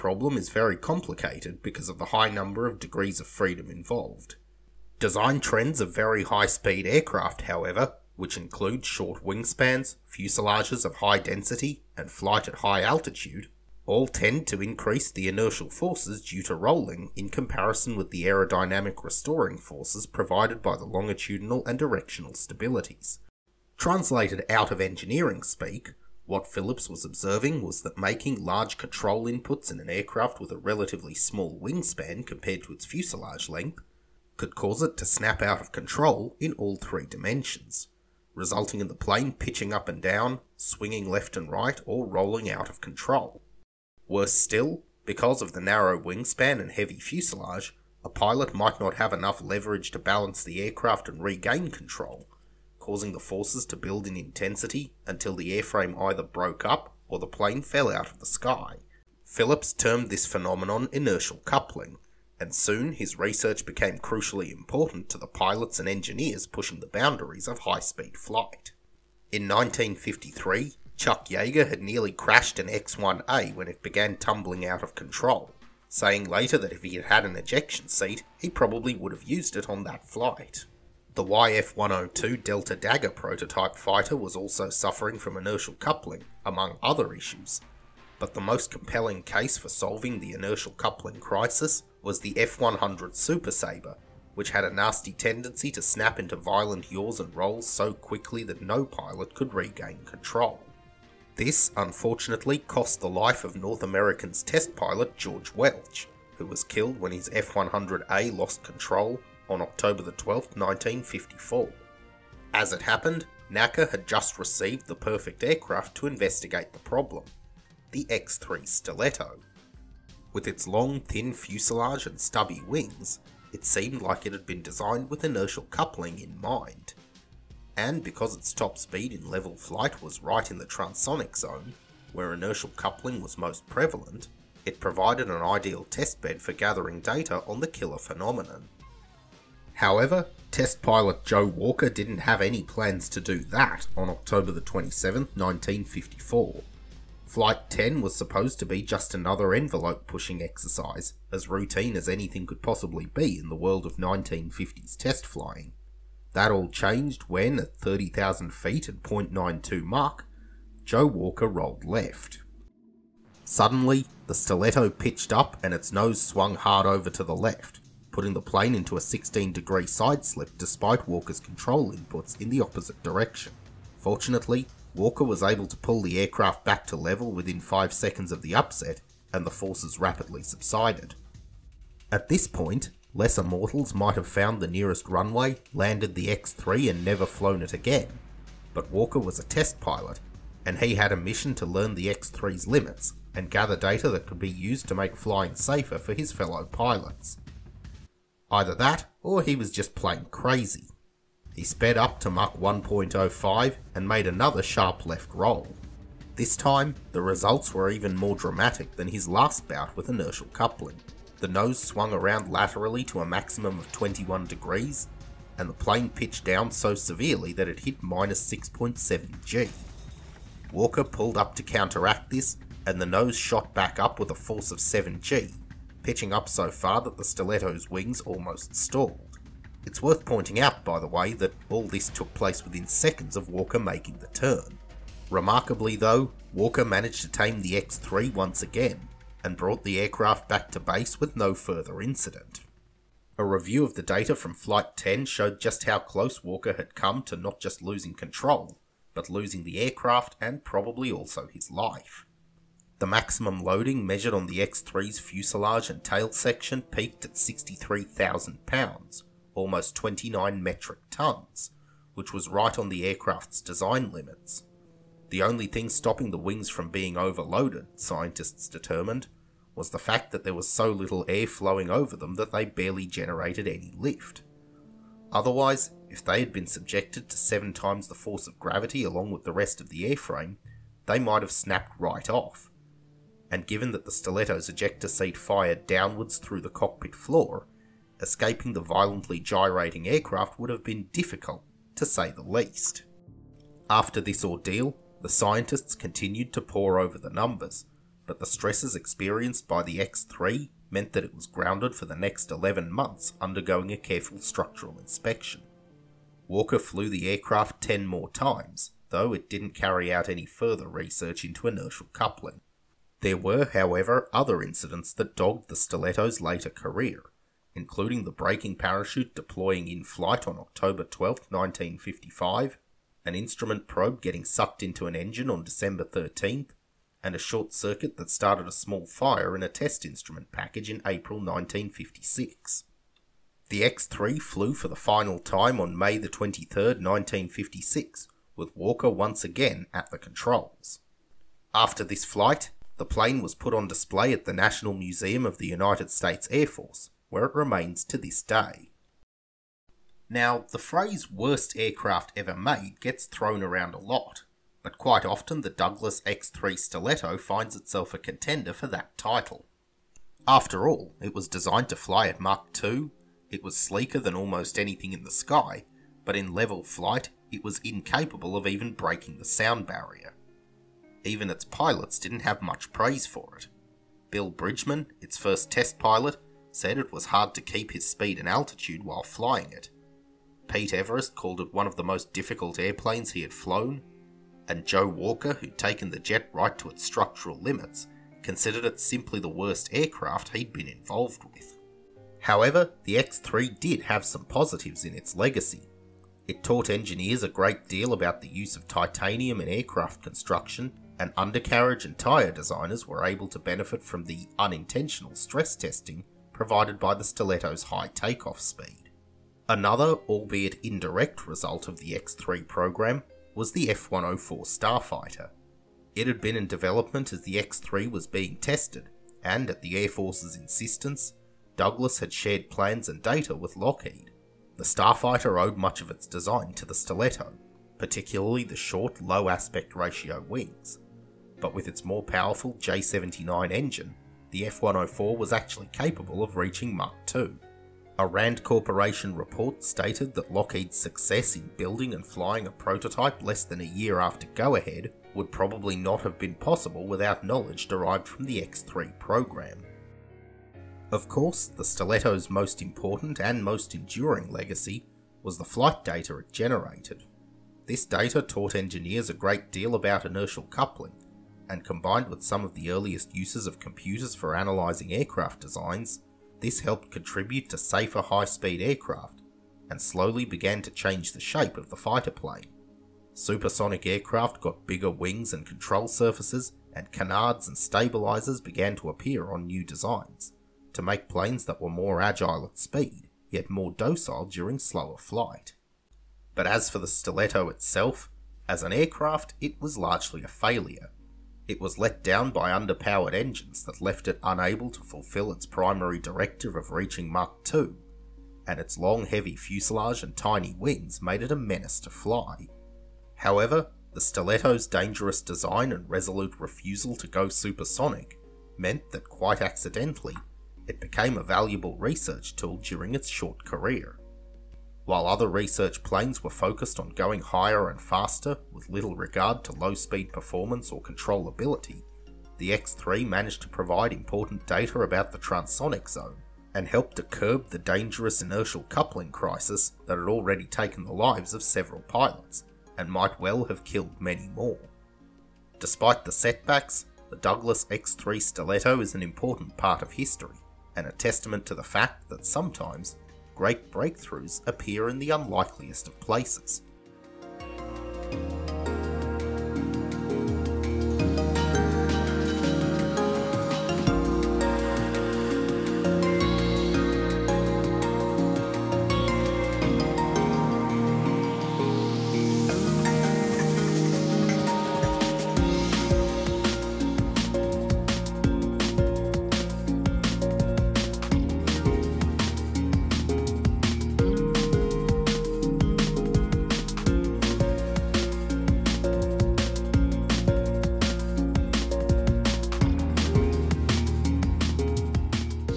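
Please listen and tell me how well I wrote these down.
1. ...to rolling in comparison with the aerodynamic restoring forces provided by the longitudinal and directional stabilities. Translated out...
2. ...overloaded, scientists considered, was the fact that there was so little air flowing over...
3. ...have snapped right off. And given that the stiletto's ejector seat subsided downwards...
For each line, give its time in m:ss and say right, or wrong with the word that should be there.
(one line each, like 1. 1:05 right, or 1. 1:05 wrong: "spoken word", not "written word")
1. 0:16 right
2. 4:27 wrong: "determined", not "considered"
3. 4:41 wrong: "fired", not "subsided".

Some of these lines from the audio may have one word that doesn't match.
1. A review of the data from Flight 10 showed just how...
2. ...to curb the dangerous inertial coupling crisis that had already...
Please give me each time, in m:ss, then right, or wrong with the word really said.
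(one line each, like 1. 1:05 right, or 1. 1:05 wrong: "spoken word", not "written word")
1. 4:03 right
2. 8:47 right.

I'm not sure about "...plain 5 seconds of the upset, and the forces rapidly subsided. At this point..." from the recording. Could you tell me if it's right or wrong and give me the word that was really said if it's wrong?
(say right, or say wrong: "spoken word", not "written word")
wrong: "within", not "plain".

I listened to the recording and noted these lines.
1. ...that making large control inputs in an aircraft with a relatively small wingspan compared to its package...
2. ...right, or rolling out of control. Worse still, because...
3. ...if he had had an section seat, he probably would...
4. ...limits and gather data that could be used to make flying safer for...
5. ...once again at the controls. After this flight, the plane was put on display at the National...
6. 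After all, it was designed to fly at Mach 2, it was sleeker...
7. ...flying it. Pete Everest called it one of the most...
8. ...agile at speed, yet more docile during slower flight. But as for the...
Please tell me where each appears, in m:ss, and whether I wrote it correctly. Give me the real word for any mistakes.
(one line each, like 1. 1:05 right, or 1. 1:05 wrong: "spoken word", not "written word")
1. 0:27 wrong: "fuselage", not "package"
2. 0:41 right
3. 1:16 wrong: "ejection", not "section"
4. 3:12 right
5. 5:39 right
6. 6:00 right
7. 6:19 right
8. 8:02 right.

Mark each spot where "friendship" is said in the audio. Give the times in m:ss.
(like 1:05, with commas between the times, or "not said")
not said.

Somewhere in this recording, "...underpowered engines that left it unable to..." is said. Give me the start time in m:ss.
8:12.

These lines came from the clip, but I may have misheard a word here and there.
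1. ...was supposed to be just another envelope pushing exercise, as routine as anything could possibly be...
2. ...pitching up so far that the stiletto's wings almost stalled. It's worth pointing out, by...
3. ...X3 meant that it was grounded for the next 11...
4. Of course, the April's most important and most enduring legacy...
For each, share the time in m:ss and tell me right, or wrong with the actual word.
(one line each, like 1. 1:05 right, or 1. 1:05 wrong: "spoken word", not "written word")
1. 2:28 right
2. 3:46 right
3. 4:59 right
4. 7:31 wrong: "Stiletto", not "April".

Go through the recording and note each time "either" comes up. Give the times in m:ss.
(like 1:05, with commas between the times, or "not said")
0:56, 3:18.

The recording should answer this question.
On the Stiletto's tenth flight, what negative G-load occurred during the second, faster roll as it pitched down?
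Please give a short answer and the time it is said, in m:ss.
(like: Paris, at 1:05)
-6.7 G, at 3:38.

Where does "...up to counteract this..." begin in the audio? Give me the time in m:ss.
3:41.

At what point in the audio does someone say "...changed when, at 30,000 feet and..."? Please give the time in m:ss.
2:36.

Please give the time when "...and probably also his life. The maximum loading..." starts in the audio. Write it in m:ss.
4:10.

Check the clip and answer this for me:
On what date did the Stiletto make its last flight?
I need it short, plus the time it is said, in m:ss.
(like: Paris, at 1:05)
May 23, 1956, at 5:35.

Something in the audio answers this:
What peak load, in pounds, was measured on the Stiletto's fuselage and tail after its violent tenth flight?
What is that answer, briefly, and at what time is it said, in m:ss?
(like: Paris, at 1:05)
63,000 pounds, at 4:17.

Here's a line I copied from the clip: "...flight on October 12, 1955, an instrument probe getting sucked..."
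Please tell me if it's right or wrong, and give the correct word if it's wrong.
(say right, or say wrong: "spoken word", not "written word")
right.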